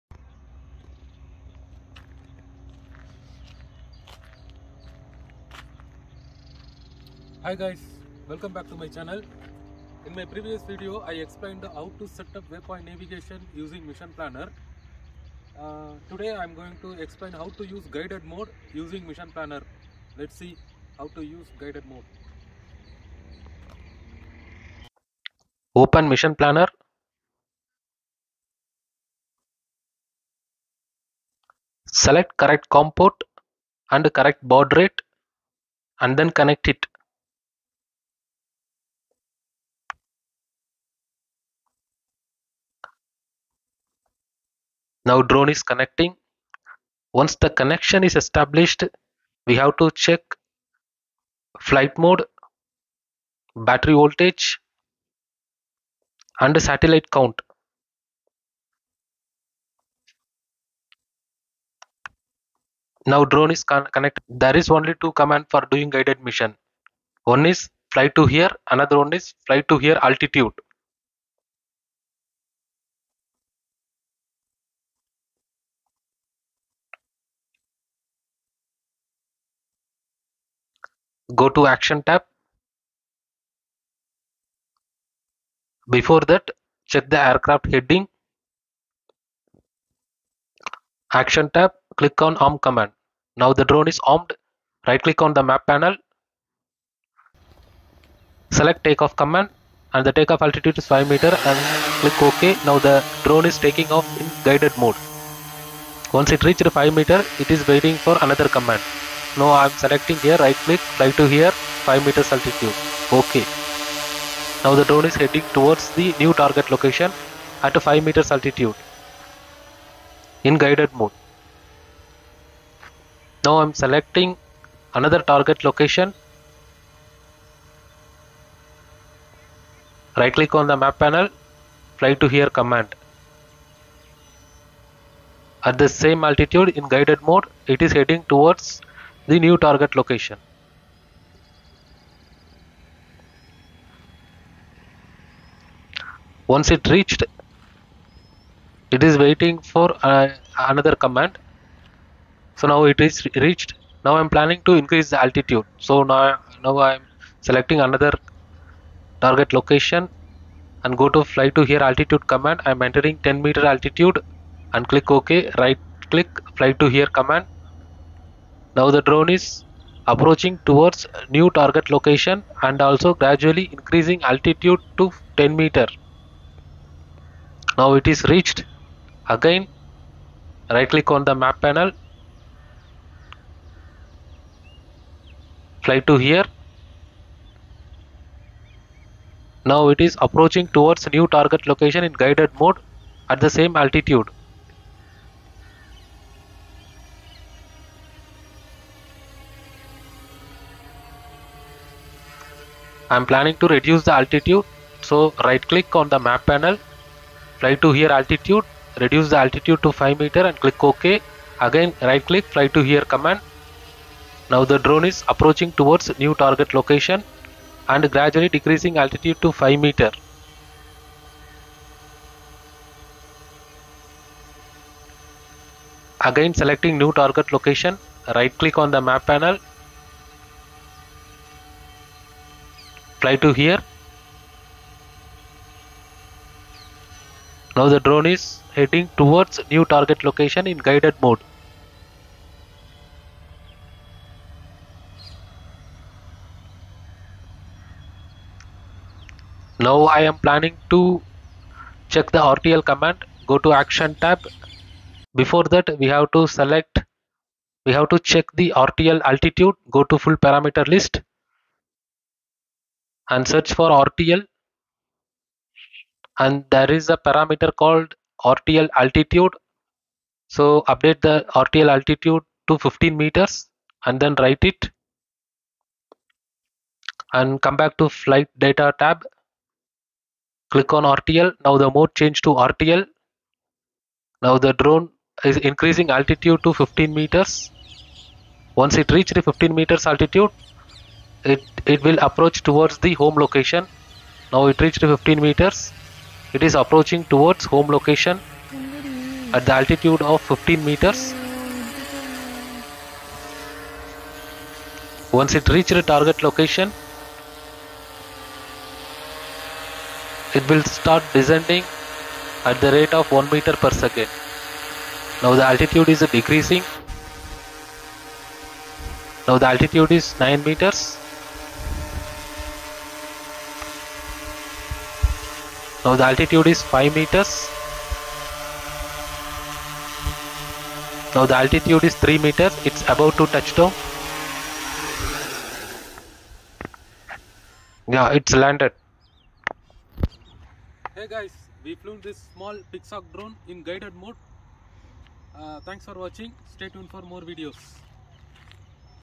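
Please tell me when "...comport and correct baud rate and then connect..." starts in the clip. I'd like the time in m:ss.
0:32.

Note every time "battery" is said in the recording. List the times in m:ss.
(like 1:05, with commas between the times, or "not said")
0:53.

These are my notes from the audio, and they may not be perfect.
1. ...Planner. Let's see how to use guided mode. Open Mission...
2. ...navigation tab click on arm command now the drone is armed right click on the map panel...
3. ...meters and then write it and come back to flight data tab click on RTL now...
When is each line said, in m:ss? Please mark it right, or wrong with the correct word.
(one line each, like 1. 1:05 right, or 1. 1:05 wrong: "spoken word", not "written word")
1. 0:19 right
2. 1:31 wrong: "action", not "navigation"
3. 4:33 right.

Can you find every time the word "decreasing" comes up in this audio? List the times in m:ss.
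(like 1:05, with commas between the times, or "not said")
3:38, 5:16.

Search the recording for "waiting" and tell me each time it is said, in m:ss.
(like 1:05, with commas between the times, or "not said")
1:47, 2:29.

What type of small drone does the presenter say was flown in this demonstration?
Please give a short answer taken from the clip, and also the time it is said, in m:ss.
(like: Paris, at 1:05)
Pixhawk, at 5:42.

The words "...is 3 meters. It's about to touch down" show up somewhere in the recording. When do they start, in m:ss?
5:32.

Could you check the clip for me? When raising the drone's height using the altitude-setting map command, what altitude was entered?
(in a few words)
10 meters.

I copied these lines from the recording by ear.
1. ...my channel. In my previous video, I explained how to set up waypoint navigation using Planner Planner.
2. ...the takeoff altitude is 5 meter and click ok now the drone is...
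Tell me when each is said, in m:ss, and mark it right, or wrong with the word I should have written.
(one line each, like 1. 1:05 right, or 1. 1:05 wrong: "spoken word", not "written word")
1. 0:08 wrong: "Mission", not "Planner"
2. 1:40 right.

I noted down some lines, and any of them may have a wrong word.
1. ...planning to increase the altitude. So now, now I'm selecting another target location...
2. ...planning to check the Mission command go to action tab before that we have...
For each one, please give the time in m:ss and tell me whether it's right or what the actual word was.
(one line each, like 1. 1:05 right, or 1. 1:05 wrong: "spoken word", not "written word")
1. 2:34 right
2. 4:10 wrong: "RTL", not "Mission".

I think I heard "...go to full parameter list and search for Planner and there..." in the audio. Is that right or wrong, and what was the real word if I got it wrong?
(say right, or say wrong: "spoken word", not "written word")
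wrong: "RTL", not "Planner".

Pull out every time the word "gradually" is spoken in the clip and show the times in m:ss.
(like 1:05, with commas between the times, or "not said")
2:53, 3:38.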